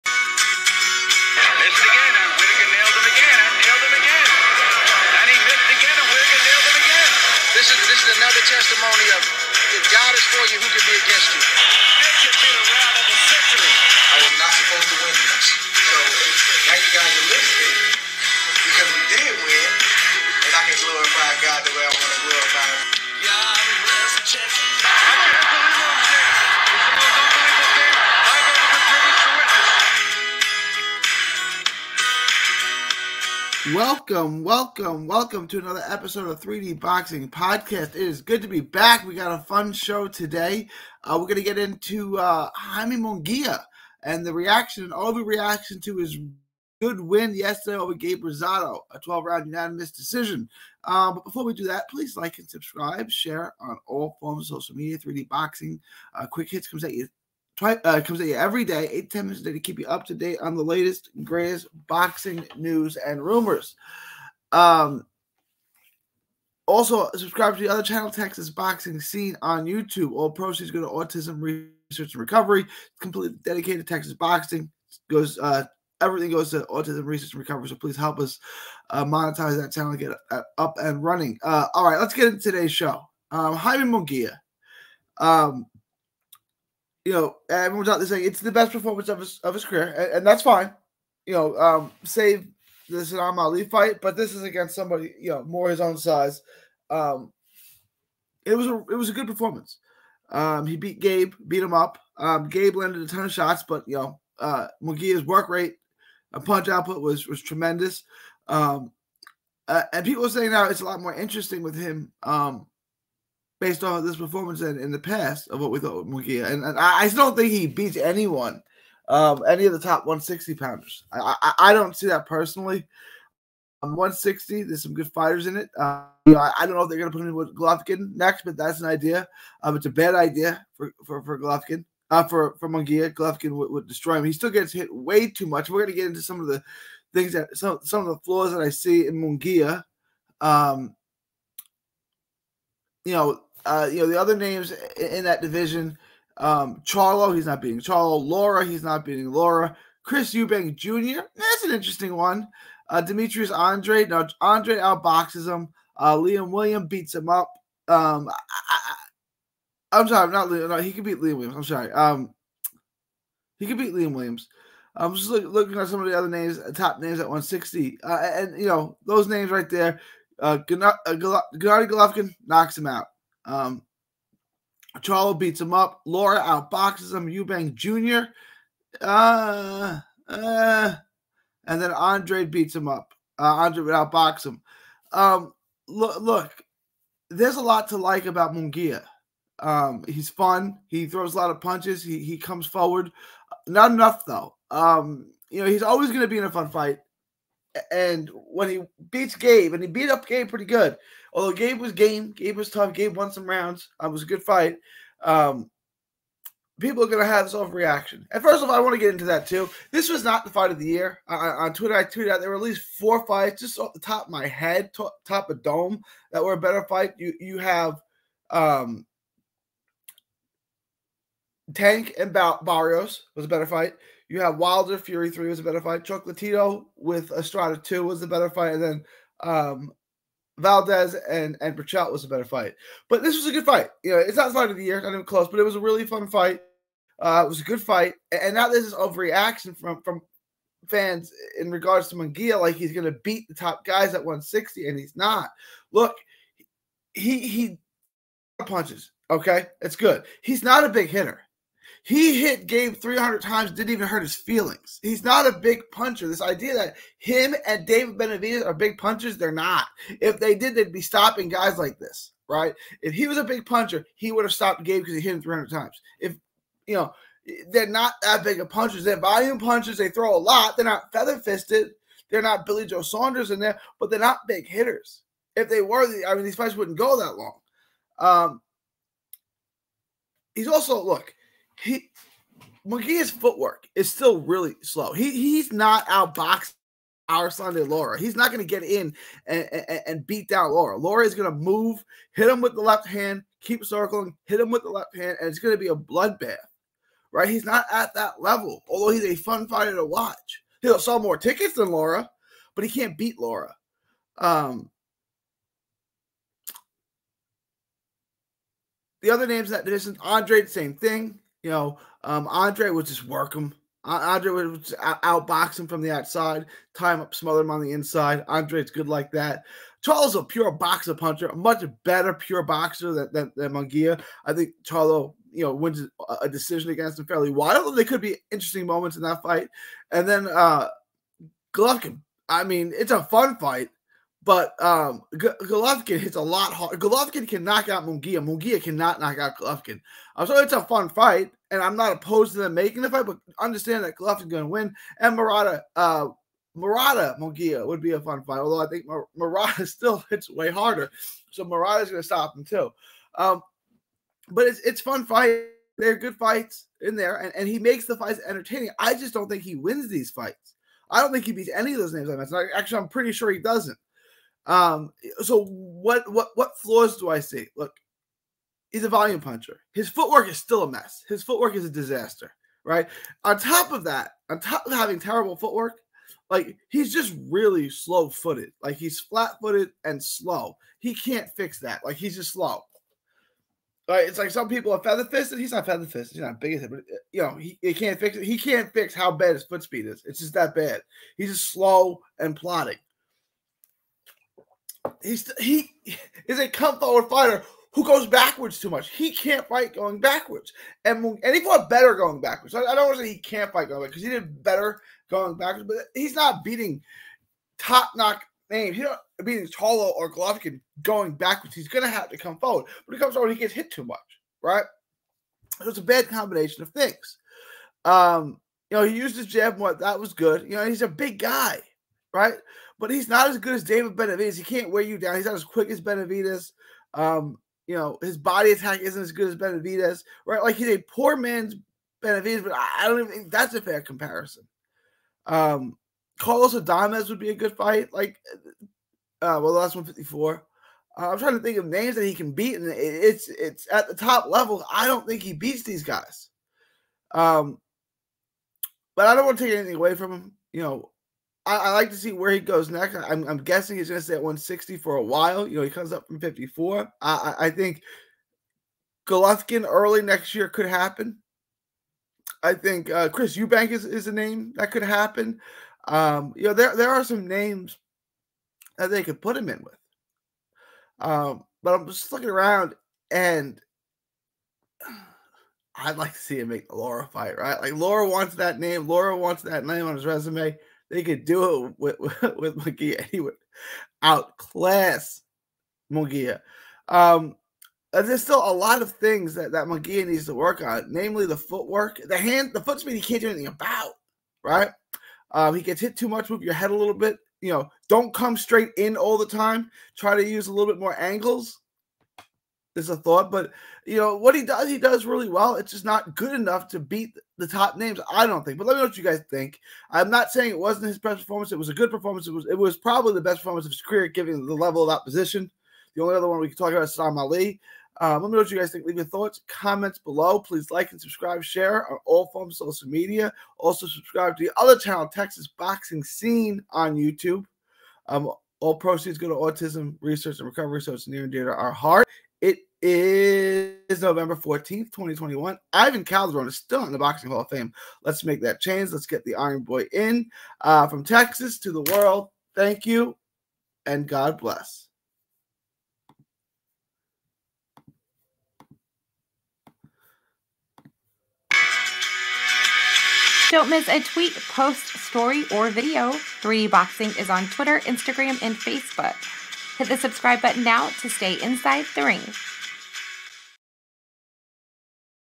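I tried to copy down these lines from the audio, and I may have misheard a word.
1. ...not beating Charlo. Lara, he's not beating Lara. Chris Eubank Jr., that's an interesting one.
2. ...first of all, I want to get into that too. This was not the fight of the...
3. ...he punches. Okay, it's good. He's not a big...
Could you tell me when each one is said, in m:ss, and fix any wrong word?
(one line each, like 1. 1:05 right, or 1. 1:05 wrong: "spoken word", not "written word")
1. 2:27 right
2. 3:28 right
3. 4:07 right.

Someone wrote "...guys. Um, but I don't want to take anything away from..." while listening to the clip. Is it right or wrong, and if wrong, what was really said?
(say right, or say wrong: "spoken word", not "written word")
right.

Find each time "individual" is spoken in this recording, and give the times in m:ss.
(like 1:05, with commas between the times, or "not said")
not said.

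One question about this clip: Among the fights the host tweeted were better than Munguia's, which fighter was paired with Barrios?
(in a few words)
Tank.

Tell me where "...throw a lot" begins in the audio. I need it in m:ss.
4:30.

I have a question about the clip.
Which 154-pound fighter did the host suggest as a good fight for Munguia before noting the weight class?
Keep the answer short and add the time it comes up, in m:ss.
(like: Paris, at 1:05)
Carlos Adames, at 7:16.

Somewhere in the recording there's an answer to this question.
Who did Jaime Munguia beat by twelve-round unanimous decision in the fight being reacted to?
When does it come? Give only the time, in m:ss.
0:47.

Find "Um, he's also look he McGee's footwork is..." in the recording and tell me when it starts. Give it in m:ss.
4:38.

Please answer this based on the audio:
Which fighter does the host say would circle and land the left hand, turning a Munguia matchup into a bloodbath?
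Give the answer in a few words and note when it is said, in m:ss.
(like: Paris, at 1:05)
Erislandy Lara, at 4:47.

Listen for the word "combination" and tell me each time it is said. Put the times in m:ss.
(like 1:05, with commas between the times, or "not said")
6:56.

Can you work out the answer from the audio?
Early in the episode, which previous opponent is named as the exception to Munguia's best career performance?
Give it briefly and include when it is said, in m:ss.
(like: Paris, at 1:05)
Saddam Ali, at 1:32.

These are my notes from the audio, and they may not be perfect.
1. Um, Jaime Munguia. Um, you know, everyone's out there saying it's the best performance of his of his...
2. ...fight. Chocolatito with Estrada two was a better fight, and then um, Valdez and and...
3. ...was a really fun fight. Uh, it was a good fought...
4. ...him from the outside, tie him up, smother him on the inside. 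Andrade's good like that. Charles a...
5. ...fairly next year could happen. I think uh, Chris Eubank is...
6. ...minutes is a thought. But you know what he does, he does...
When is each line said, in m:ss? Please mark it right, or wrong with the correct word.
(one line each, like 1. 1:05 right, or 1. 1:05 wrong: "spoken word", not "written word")
1. 1:23 right
2. 3:45 right
3. 3:55 wrong: "fight", not "fought"
4. 5:15 right
5. 7:39 wrong: "early", not "fairly"
6. 8:21 wrong: "angles", not "minutes".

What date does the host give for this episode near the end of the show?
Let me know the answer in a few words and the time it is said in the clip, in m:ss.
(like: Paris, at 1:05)
November 14th, 2021, at 8:54.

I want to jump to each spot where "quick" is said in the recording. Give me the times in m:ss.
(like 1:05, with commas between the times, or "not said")
0:56, 7:05.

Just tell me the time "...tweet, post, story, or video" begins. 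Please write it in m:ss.
9:14.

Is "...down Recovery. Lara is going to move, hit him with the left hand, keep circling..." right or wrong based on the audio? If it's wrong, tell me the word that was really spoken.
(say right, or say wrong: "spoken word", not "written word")
wrong: "Lara", not "Recovery".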